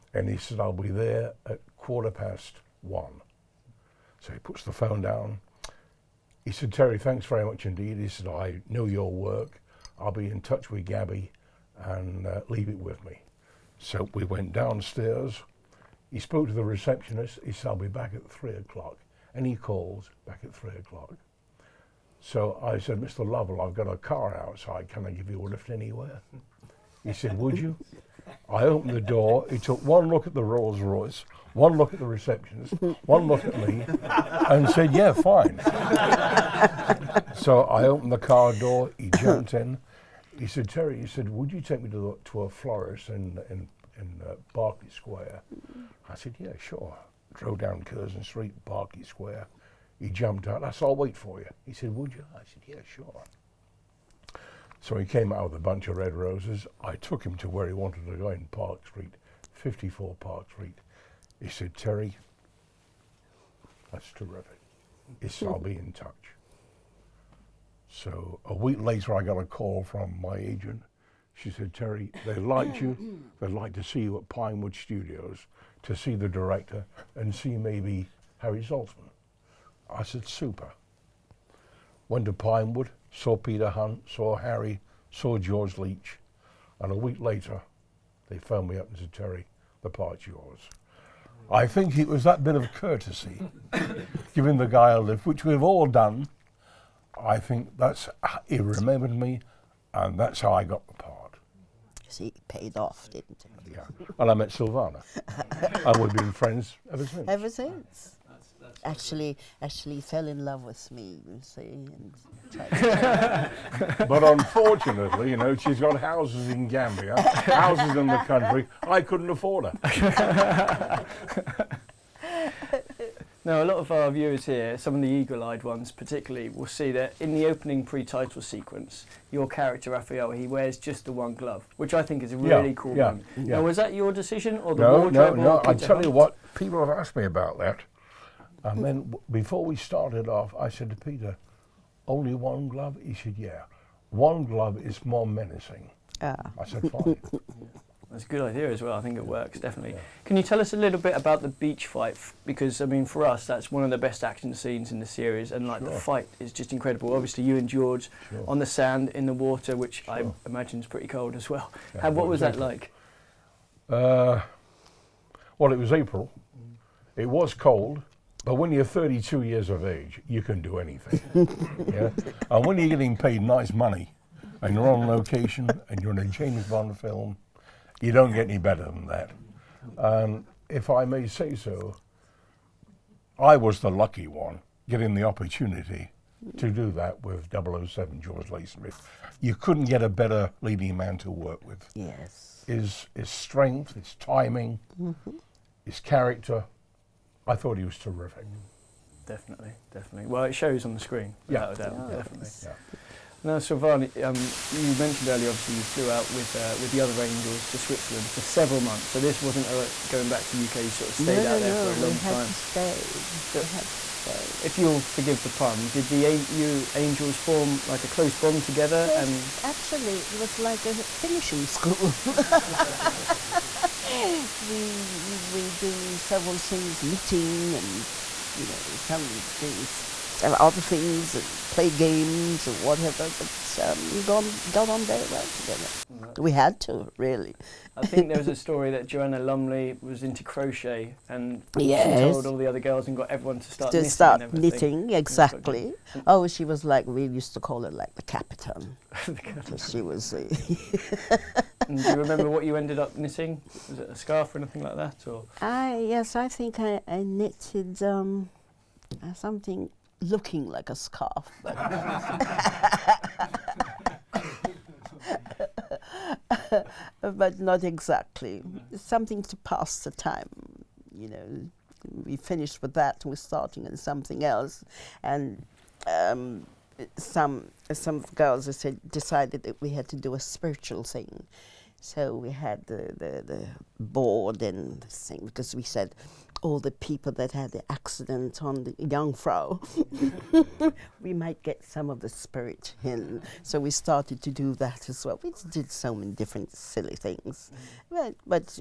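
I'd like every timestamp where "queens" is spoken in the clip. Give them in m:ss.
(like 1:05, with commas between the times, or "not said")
not said.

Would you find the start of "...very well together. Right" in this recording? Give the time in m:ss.
3:55.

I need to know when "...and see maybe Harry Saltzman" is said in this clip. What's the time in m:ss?
1:17.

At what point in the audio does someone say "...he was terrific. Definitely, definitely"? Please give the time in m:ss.
3:17.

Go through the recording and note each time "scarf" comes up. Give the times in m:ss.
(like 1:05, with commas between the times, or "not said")
4:14, 4:20.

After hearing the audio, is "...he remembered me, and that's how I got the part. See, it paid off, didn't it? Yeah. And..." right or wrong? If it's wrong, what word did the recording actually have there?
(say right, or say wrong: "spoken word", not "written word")
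right.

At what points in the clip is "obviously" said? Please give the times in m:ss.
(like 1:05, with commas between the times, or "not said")
2:37, 3:25.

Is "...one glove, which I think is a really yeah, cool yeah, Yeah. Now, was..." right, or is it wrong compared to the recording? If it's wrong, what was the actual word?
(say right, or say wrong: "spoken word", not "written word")
right.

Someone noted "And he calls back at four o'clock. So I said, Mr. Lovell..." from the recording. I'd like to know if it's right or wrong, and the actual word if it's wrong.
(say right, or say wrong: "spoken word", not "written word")
wrong: "three", not "four".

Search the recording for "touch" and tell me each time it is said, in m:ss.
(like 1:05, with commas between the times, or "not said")
0:10, 1:05.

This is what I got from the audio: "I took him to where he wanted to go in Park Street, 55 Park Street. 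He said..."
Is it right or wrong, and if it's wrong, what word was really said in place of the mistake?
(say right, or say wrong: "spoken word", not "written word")
wrong: "54", not "55".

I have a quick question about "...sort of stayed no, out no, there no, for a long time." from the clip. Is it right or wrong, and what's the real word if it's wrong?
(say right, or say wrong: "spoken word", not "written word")
right.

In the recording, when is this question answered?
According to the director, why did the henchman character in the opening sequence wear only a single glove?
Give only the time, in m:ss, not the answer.
2:25.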